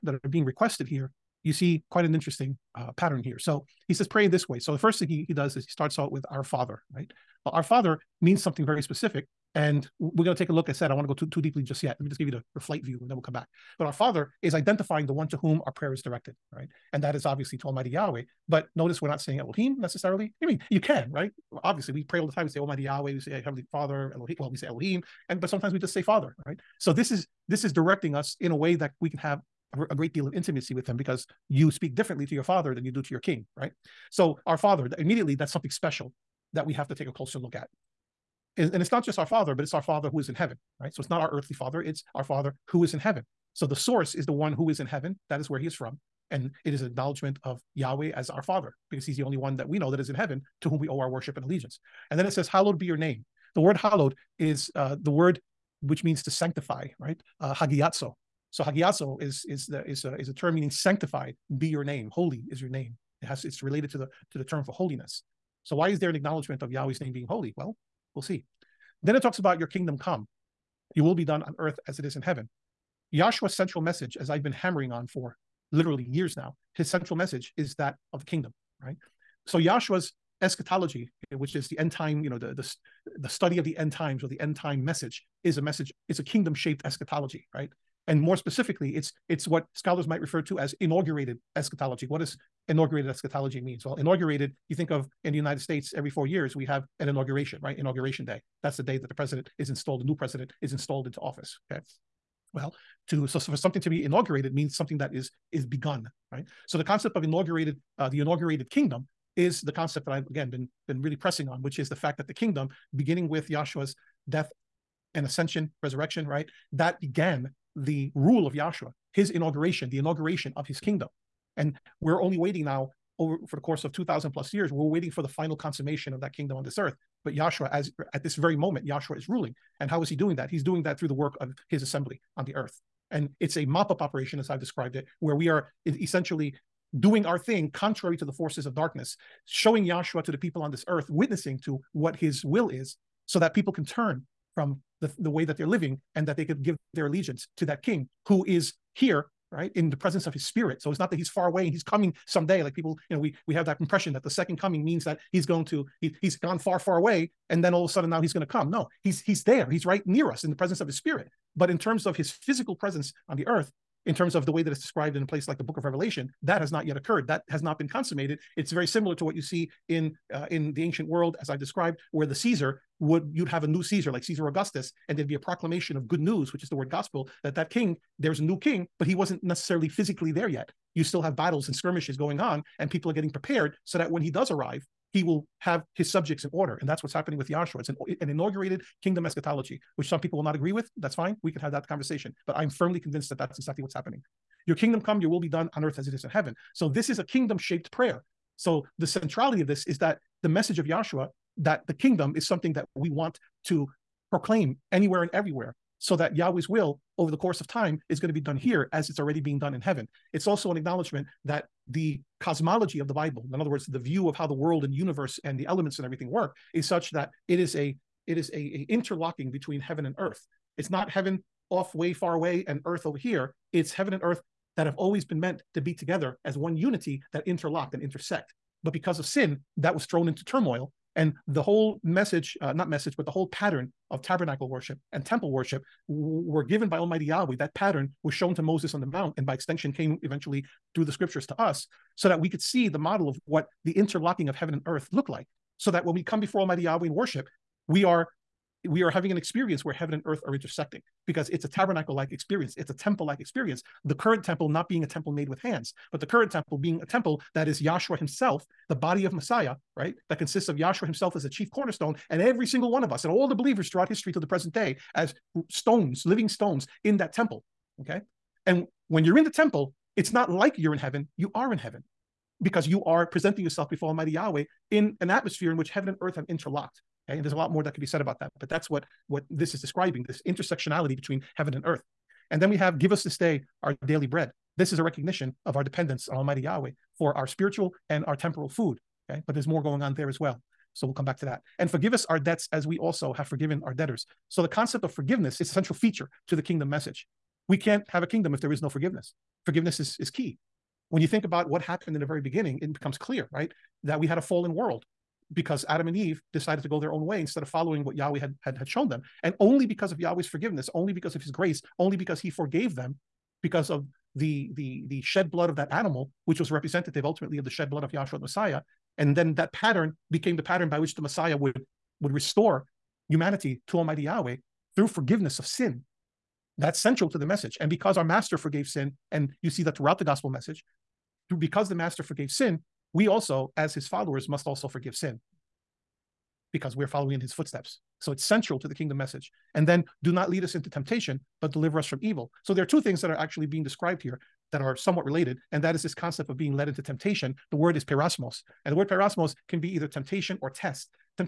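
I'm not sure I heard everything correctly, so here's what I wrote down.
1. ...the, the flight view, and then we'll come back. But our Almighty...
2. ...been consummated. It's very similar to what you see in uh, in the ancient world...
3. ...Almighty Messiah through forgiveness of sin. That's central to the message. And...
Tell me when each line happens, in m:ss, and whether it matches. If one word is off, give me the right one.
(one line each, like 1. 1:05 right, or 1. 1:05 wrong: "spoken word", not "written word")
1. 0:12 wrong: "Father", not "Almighty"
2. 2:47 right
3. 5:23 wrong: "Yahweh", not "Messiah".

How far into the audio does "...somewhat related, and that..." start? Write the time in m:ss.
5:44.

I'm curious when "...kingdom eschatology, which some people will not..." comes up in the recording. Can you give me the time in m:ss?
3:09.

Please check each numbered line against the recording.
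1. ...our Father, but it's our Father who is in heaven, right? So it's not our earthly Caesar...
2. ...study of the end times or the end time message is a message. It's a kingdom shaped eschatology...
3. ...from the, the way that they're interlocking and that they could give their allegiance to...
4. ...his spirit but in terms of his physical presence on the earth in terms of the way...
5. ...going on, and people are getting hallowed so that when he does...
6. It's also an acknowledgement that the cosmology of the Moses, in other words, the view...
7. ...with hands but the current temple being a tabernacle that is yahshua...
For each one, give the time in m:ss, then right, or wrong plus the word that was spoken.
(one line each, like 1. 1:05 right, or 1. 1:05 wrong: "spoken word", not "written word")
1. 0:39 wrong: "Father", not "Caesar"
2. 1:23 right
3. 2:24 wrong: "living", not "interlocking"
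4. 2:40 right
5. 3:02 wrong: "prepared", not "hallowed"
6. 3:30 wrong: "Bible", not "Moses"
7. 4:15 wrong: "temple", not "tabernacle".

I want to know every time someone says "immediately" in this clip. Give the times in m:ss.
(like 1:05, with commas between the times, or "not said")
0:34.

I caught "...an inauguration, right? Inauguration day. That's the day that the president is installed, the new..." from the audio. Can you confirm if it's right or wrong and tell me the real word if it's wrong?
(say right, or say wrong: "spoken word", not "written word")
right.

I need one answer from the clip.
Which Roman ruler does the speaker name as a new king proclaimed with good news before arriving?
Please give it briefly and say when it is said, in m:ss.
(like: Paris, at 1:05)
Caesar Augustus, at 2:54.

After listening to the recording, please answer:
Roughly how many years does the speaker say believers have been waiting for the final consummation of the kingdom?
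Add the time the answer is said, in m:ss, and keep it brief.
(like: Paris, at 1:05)
2000 plus years, at 2:03.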